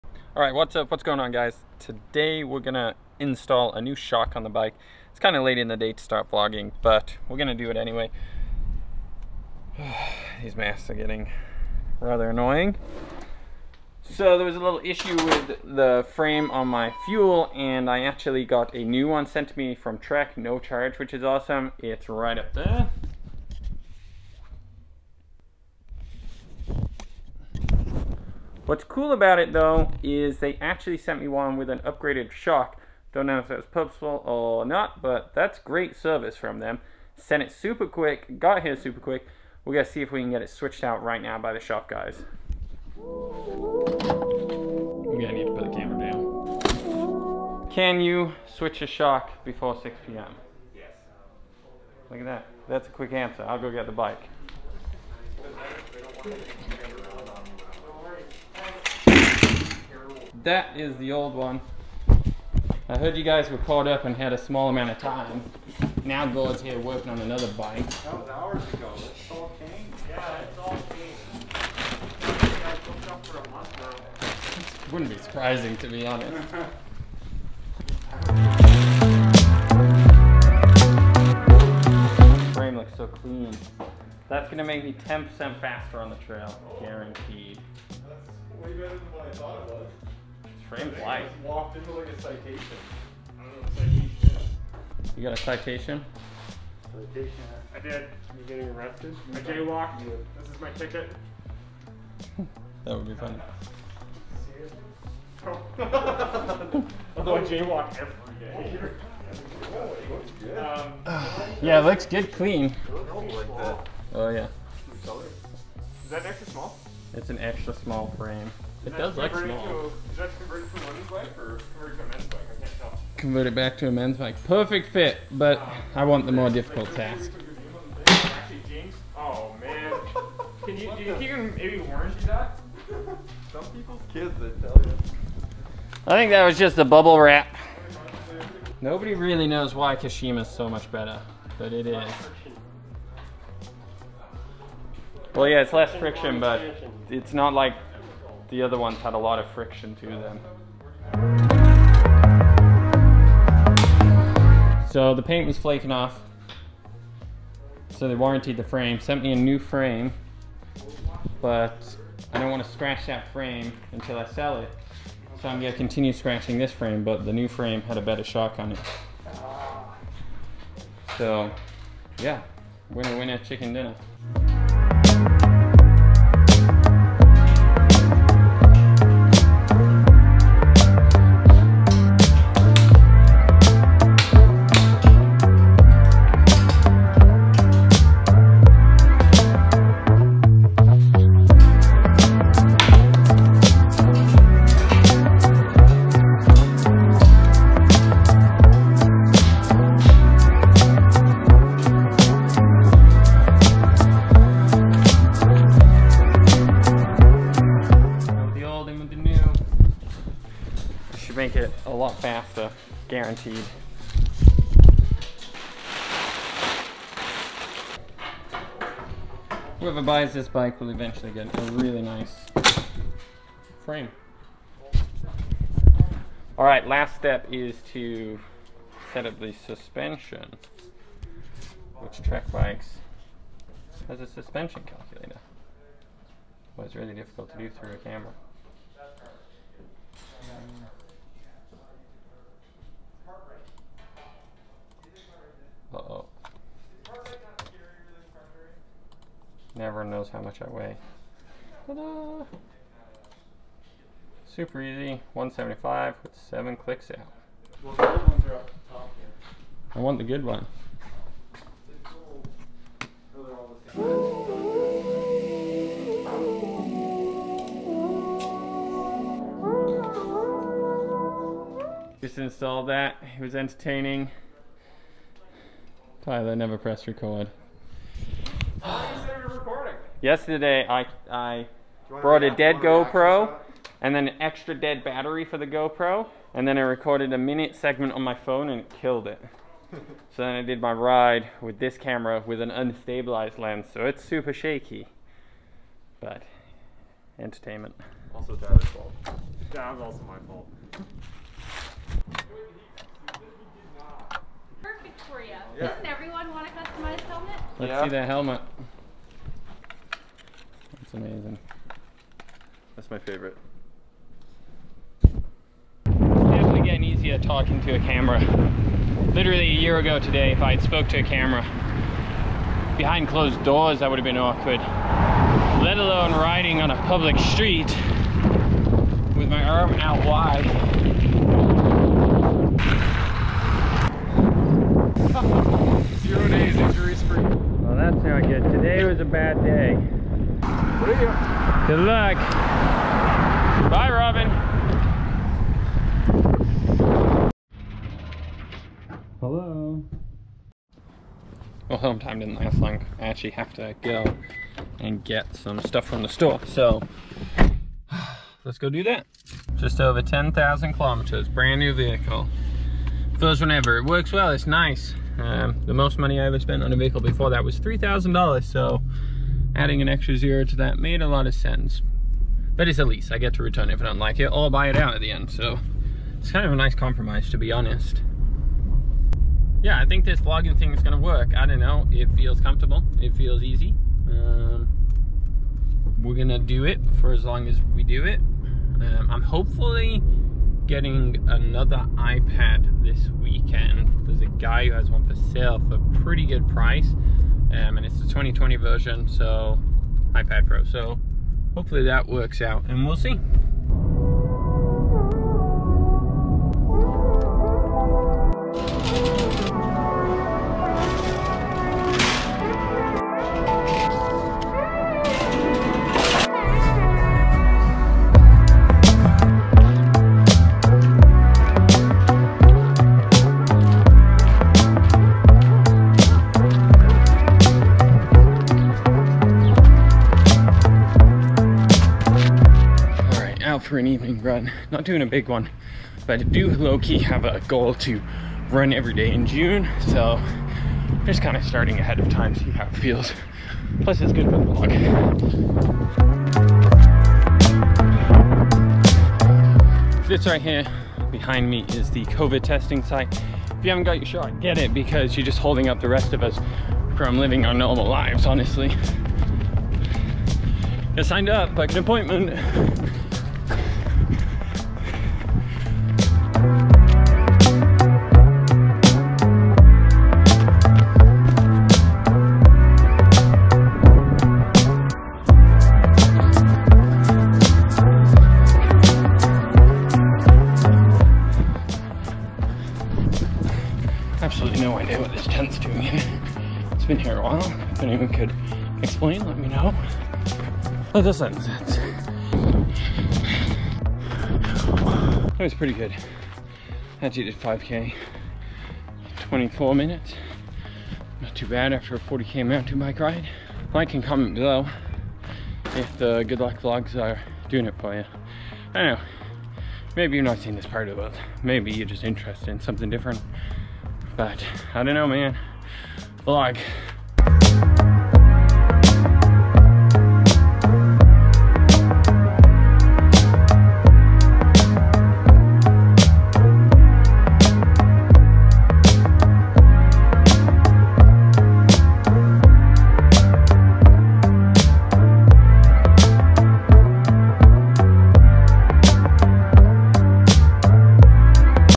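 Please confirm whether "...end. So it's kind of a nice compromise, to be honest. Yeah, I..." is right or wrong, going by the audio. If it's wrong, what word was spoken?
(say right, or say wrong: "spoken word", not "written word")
right.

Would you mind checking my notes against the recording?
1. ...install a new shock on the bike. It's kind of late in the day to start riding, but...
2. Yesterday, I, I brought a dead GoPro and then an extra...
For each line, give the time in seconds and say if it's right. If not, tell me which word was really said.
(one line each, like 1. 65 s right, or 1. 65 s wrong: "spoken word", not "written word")
1. 3 s wrong: "vlogging", not "riding"
2. 280 s right.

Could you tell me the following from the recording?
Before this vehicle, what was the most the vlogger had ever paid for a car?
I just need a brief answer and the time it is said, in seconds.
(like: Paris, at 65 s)
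$3,000, at 367 s.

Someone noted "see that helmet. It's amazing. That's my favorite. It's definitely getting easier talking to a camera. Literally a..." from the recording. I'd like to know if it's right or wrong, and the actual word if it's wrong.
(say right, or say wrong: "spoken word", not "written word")
right.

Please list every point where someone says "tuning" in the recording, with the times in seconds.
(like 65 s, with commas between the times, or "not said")
not said.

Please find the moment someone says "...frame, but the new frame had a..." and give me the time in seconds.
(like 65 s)
166 s.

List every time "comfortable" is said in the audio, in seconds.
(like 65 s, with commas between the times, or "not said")
382 s.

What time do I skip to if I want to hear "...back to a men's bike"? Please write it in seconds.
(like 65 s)
123 s.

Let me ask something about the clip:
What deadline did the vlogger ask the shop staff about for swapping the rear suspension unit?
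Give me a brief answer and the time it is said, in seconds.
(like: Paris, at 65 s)
6 p.m., at 49 s.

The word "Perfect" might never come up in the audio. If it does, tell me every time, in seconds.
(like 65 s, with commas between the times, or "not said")
124 s, 304 s.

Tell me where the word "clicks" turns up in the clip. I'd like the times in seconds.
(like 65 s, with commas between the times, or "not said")
256 s.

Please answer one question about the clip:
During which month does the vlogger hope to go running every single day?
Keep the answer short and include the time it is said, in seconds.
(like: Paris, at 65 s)
June, at 439 s.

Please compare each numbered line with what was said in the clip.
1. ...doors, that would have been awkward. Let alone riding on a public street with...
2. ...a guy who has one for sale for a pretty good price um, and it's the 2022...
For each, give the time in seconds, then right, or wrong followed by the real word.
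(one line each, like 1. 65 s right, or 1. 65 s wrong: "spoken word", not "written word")
1. 323 s right
2. 394 s wrong: "2020", not "2022".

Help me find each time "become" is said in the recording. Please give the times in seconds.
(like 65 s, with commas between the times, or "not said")
not said.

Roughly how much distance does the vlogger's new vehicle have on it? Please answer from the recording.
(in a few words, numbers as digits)
10,000 kilometers.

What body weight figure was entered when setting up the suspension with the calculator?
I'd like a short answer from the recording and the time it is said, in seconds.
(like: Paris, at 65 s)
175, at 255 s.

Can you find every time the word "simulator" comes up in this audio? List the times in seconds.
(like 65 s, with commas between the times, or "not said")
not said.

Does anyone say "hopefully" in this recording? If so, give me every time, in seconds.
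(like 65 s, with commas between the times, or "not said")
389 s, 401 s.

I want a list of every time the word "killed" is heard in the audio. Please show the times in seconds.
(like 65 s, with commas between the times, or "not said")
289 s.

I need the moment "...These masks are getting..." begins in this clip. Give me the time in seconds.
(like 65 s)
10 s.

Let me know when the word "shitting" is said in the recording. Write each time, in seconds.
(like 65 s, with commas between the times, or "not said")
not said.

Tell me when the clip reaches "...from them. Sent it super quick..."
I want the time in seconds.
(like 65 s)
36 s.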